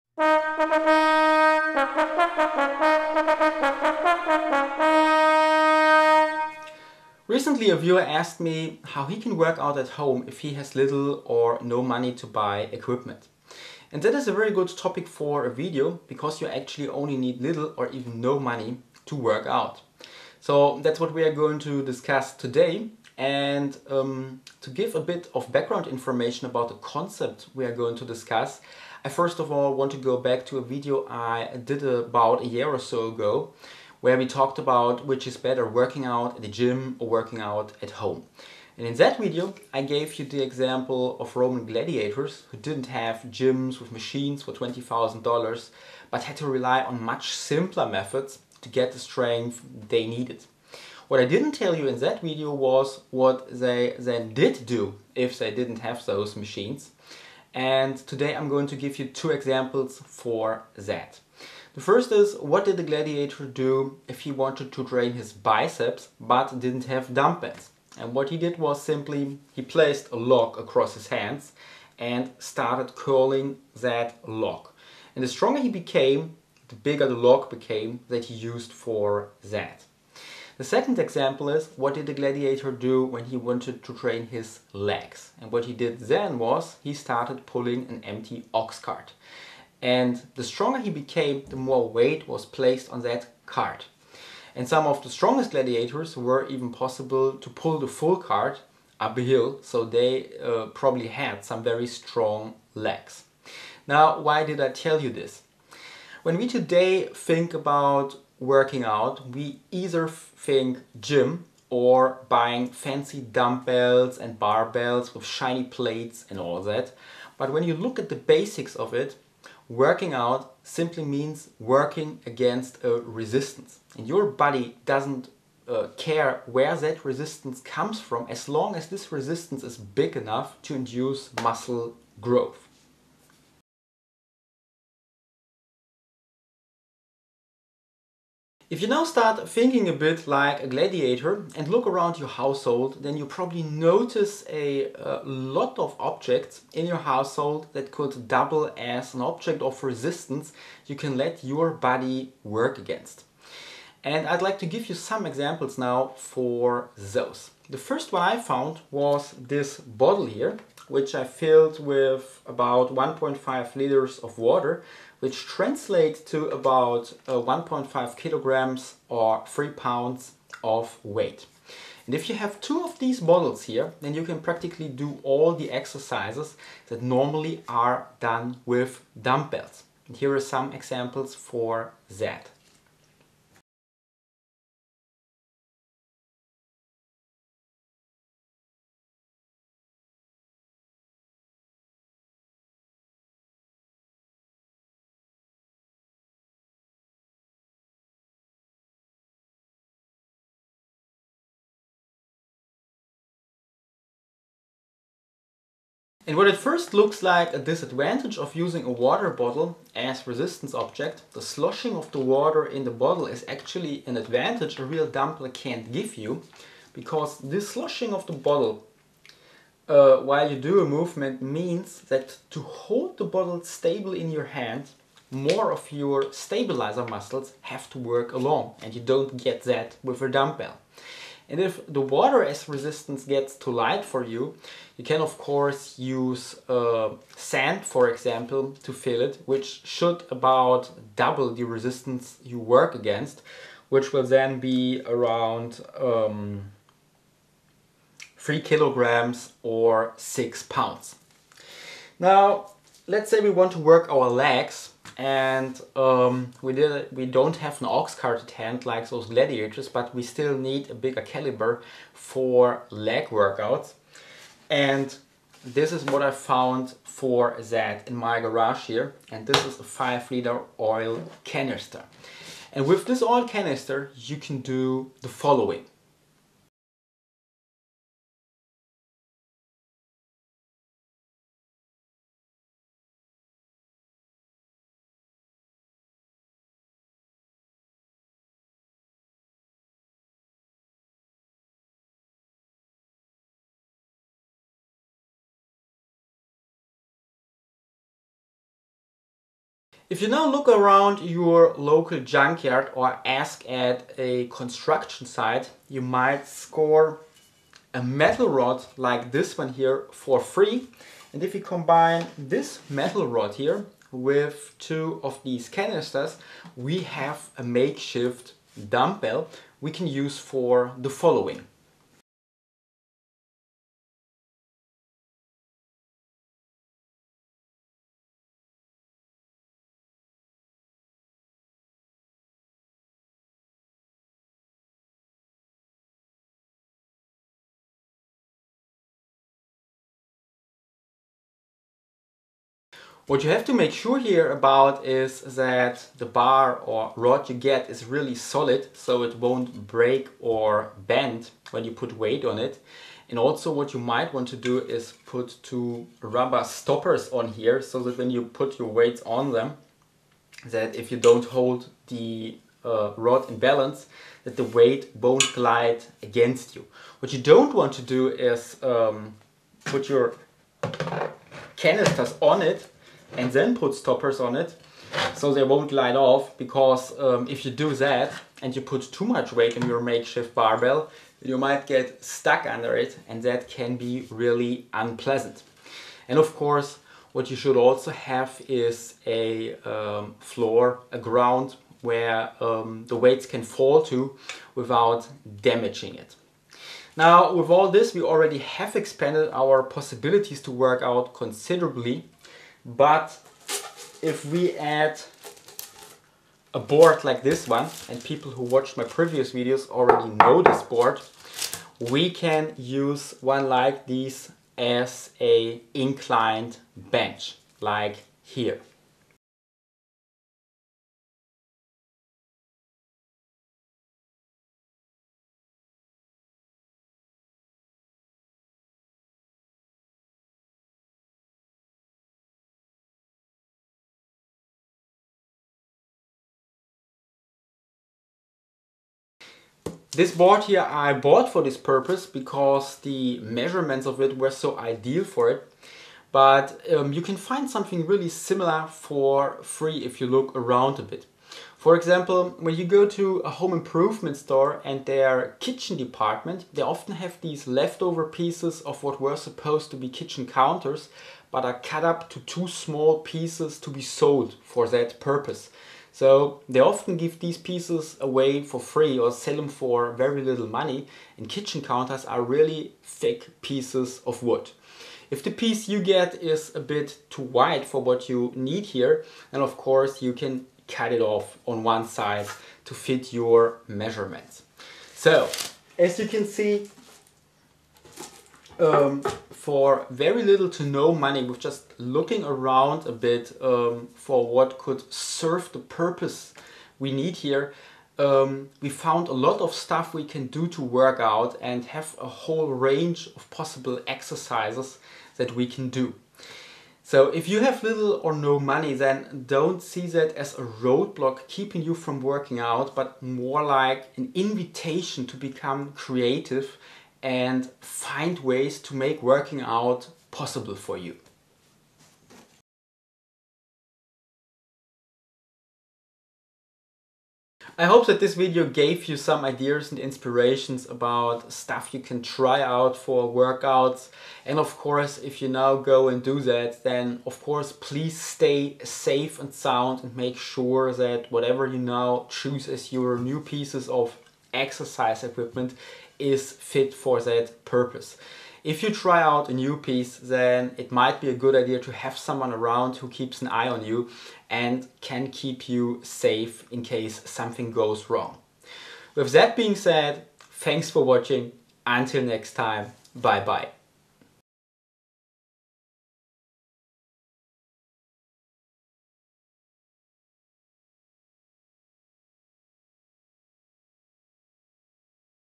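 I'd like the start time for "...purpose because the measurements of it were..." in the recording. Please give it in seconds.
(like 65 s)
441 s.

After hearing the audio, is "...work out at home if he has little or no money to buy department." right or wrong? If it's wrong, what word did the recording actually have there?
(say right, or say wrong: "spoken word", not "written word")
wrong: "equipment", not "department".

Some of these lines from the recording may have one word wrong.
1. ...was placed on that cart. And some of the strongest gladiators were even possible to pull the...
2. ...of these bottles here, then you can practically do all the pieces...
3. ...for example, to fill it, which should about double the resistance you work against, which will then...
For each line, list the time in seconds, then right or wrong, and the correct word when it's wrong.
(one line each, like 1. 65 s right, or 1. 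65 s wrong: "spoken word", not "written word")
1. 92 s right
2. 172 s wrong: "exercises", not "pieces"
3. 237 s right.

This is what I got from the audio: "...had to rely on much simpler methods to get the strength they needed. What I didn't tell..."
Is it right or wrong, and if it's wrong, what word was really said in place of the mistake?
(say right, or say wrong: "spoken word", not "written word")
right.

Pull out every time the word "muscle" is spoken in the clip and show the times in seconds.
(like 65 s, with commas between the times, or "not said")
131 s, 227 s.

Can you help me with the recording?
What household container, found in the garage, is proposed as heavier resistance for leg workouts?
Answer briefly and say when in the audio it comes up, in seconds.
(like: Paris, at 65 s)
A 5 liter oil canister, at 269 s.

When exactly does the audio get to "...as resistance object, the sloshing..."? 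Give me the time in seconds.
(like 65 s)
209 s.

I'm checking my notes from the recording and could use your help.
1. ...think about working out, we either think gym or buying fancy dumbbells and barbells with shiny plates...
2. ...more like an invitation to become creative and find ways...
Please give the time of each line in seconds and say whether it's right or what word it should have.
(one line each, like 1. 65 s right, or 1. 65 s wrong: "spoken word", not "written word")
1. 107 s right
2. 513 s right.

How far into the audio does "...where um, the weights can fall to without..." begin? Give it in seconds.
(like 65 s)
392 s.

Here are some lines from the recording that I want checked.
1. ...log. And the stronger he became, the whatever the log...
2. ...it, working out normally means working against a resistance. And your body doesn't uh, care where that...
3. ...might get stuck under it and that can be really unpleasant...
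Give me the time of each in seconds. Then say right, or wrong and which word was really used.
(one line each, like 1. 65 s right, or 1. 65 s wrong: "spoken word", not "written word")
1. 74 s wrong: "bigger", not "whatever"
2. 118 s wrong: "simply", not "normally"
3. 381 s right.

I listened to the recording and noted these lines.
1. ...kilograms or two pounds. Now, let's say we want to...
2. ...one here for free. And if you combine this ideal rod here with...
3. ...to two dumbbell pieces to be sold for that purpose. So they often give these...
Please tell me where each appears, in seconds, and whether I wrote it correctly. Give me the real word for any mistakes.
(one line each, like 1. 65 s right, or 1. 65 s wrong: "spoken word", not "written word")
1. 248 s wrong: "six", not "two"
2. 309 s wrong: "metal", not "ideal"
3. 462 s wrong: "small", not "dumbbell".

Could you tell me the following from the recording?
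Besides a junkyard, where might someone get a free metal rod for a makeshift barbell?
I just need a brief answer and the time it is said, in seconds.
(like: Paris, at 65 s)
A construction site, at 304 s.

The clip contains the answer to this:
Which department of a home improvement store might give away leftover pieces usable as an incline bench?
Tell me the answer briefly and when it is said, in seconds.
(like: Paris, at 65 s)
Kitchen department, at 455 s.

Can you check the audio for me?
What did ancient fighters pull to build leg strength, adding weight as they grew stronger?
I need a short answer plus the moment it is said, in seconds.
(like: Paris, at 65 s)
An empty ox cart, at 88 s.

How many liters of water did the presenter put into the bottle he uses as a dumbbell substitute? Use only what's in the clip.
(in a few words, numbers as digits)
1.5 liters.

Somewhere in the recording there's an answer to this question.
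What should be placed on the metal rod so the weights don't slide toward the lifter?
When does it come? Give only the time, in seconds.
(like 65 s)
356 s.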